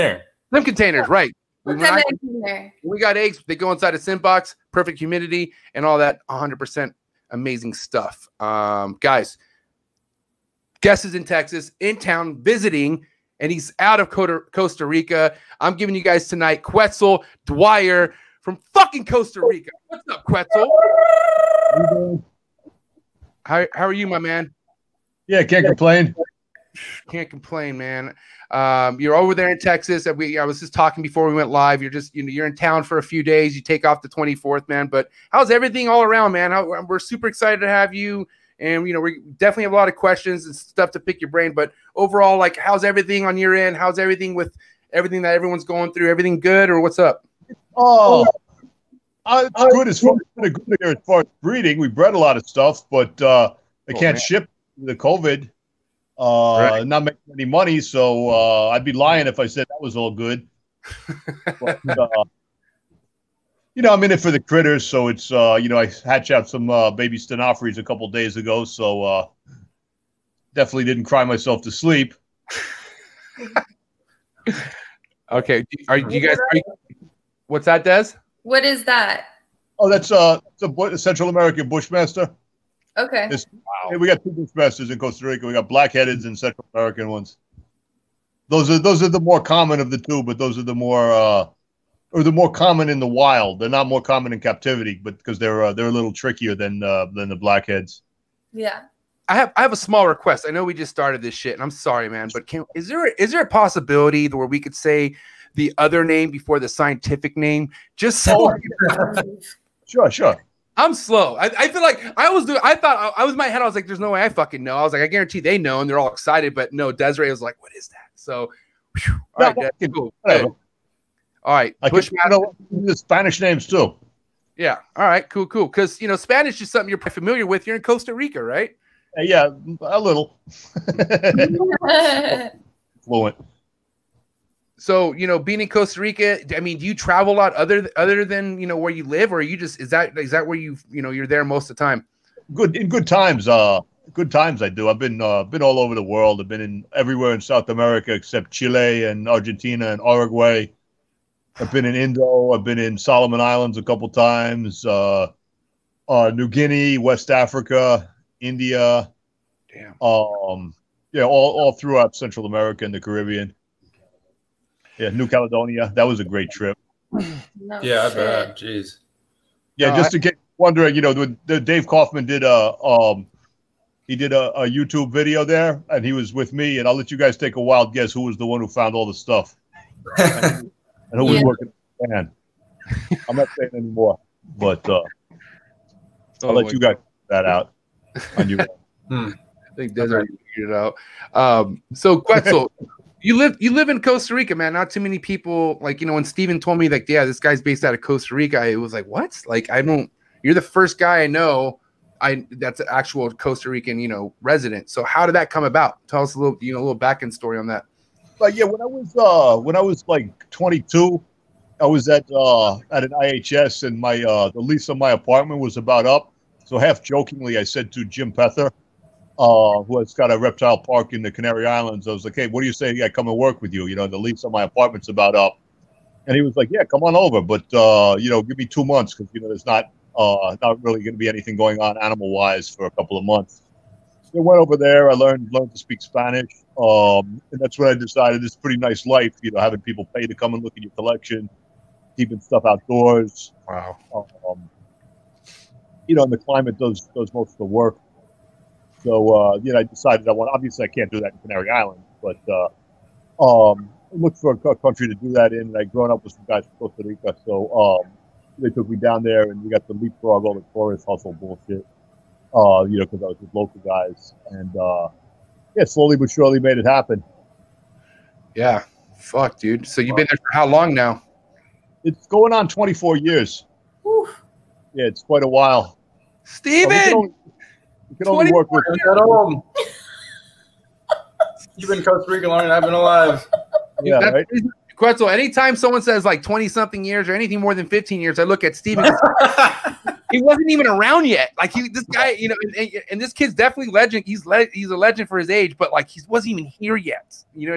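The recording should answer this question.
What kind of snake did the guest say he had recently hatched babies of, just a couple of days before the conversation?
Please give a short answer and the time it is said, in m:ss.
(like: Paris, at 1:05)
Stenophores, at 1:07.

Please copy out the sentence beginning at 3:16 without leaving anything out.
When Steven told me like, yeah, this guy's based out of Costa Rica, it was like, what?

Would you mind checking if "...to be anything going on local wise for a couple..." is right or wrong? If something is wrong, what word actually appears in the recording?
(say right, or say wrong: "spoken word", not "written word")
wrong: "animal", not "local".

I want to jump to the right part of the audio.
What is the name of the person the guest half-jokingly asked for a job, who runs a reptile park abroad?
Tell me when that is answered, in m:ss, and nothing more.
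3:38.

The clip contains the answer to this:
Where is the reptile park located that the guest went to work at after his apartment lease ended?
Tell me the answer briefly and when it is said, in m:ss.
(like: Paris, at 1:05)
Canary Islands, at 3:41.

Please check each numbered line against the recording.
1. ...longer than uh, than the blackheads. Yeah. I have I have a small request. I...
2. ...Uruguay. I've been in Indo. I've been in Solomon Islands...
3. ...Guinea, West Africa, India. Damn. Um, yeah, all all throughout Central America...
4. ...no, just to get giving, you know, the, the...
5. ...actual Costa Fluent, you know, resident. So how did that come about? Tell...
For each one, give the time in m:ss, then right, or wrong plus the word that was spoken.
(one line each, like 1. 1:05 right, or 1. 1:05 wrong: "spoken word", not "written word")
1. 1:36 wrong: "trickier", not "longer"
2. 2:30 right
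3. 2:36 right
4. 2:49 wrong: "wondering", not "giving"
5. 3:22 wrong: "Rican", not "Fluent".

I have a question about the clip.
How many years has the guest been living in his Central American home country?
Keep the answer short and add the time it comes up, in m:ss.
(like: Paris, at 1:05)
24, at 4:32.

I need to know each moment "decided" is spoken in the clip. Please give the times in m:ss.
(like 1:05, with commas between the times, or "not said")
3:57, 4:09.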